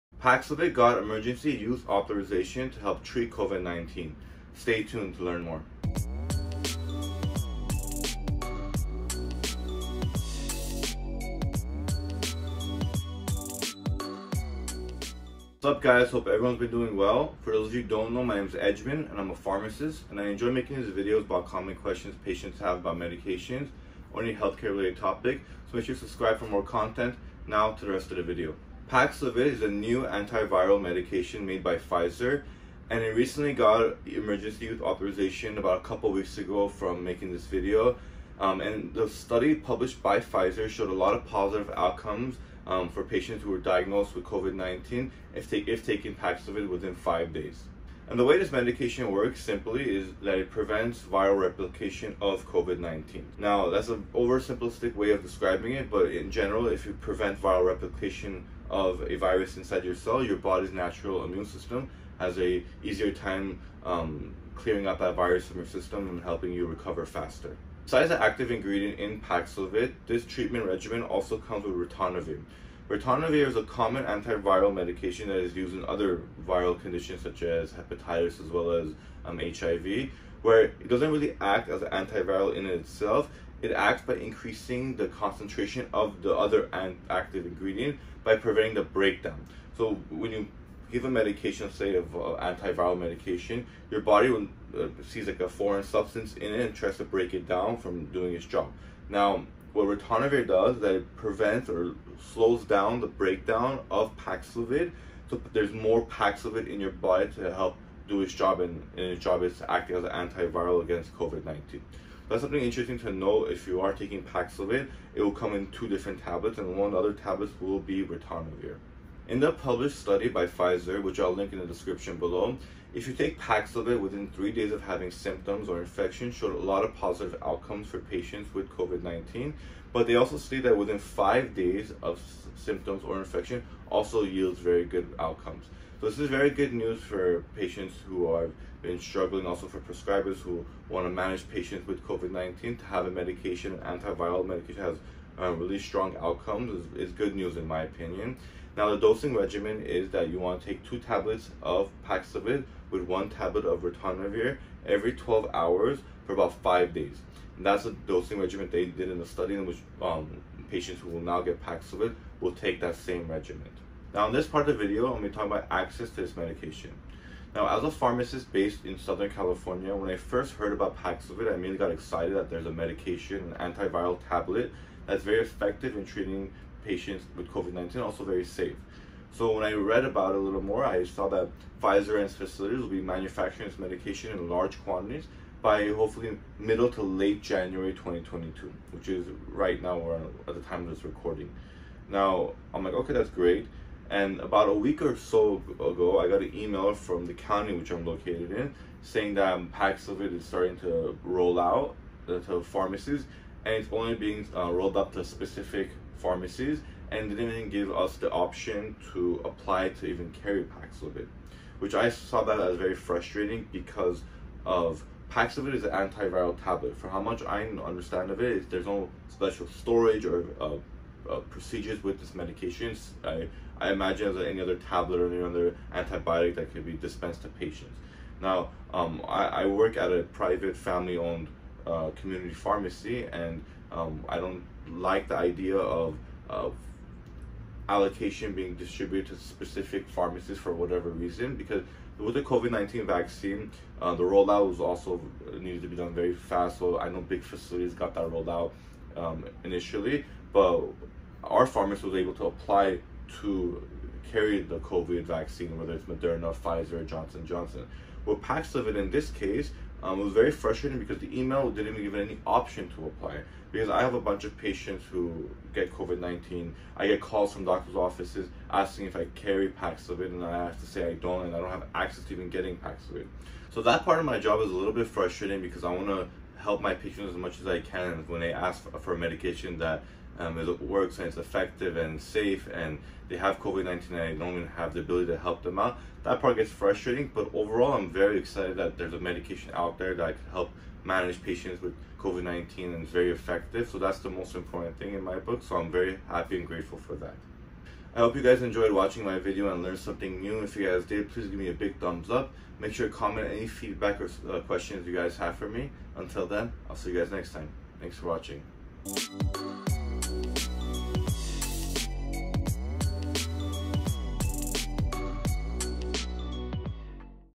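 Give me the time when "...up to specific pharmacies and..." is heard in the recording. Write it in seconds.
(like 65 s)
204 s.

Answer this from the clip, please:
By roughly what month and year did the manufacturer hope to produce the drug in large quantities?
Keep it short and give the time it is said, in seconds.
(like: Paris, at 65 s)
January 2022, at 187 s.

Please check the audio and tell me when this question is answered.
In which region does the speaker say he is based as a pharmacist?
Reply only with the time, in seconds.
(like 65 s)
168 s.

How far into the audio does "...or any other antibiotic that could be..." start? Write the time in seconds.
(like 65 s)
225 s.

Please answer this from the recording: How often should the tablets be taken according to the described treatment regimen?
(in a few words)
Every 12 hours.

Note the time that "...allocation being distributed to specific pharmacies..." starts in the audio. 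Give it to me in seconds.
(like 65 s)
237 s.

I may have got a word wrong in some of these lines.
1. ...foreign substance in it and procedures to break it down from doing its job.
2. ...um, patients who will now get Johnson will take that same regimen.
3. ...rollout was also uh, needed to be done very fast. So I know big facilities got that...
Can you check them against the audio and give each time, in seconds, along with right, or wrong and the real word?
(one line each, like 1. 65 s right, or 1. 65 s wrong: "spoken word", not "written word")
1. 95 s wrong: "tries", not "procedures"
2. 160 s wrong: "Paxlovid", not "Johnson"
3. 244 s right.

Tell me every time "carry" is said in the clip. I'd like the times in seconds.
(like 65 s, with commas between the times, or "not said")
210 s, 254 s, 269 s.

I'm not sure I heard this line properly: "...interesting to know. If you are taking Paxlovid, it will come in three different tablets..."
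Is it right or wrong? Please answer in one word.
wrong.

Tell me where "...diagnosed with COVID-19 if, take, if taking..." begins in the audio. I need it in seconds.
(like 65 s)
43 s.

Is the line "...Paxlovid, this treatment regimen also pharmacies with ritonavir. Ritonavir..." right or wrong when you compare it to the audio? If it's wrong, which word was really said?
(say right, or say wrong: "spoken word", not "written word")
wrong: "comes", not "pharmacies".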